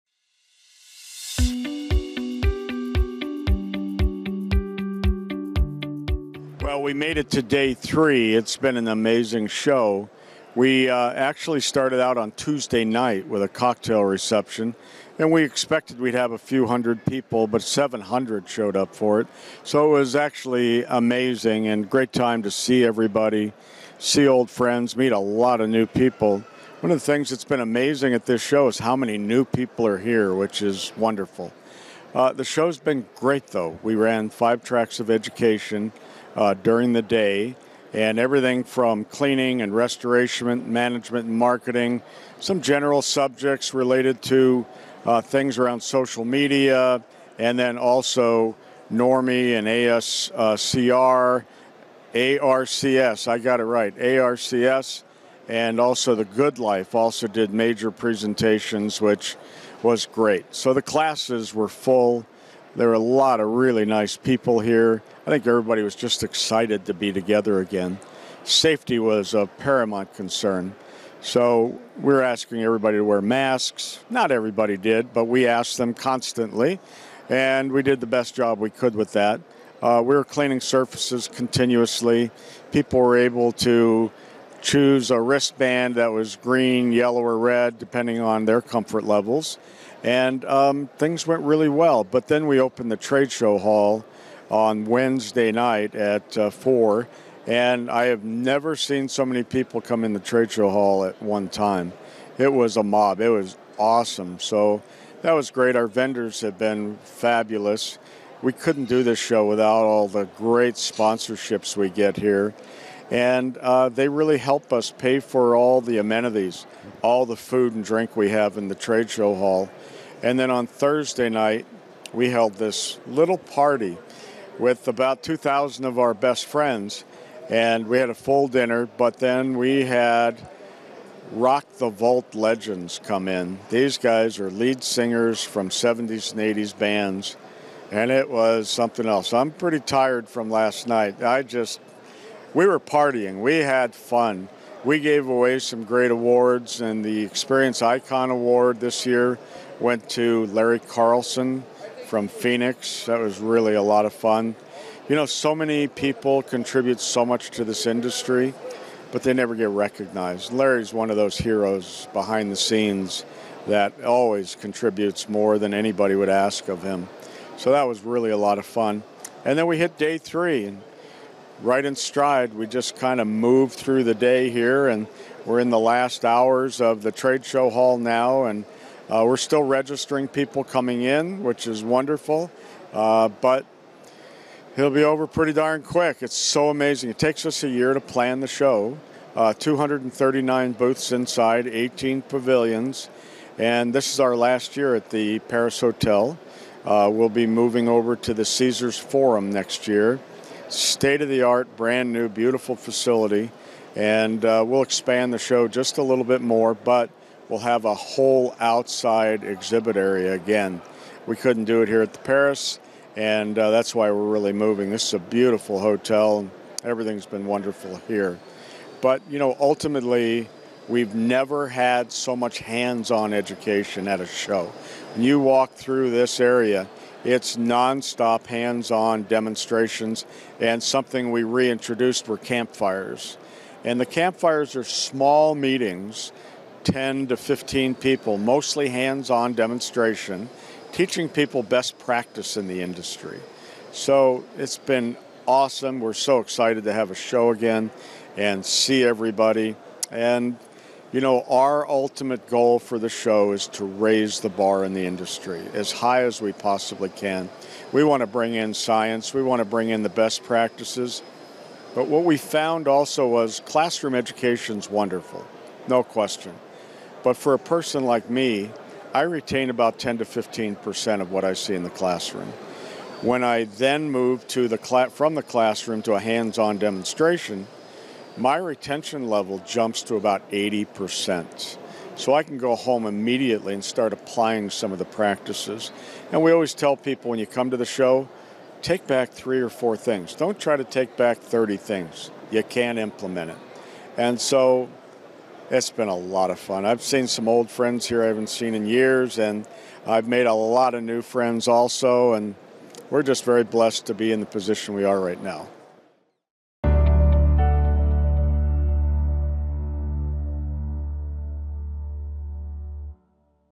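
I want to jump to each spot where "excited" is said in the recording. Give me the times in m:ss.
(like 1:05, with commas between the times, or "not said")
1:06, 4:06.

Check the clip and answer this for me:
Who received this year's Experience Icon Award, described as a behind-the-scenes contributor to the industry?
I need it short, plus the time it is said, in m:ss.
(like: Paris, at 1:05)
Larry Carlson, at 2:30.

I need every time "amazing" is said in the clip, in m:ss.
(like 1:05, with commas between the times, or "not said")
0:08, 0:20, 0:27, 3:06.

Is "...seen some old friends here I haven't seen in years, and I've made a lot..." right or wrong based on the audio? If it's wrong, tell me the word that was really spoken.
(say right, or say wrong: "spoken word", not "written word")
right.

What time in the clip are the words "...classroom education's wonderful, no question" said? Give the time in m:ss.
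4:23.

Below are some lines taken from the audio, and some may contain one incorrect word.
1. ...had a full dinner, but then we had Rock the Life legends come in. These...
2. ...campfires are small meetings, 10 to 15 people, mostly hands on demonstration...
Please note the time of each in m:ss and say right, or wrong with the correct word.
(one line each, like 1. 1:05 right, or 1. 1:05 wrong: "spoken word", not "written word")
1. 2:07 wrong: "Vault", not "Life"
2. 3:54 right.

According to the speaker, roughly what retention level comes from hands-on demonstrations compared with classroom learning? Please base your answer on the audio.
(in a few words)
80%.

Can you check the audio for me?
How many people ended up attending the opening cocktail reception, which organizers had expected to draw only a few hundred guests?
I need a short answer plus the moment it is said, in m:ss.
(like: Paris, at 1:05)
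700, at 0:17.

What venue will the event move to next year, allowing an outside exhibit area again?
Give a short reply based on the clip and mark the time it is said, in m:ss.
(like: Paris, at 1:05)
Caesars Forum, at 3:18.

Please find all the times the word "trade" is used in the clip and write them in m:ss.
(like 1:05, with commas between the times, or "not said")
1:32, 1:40, 1:58, 2:57.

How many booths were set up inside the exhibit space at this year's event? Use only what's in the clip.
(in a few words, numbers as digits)
239.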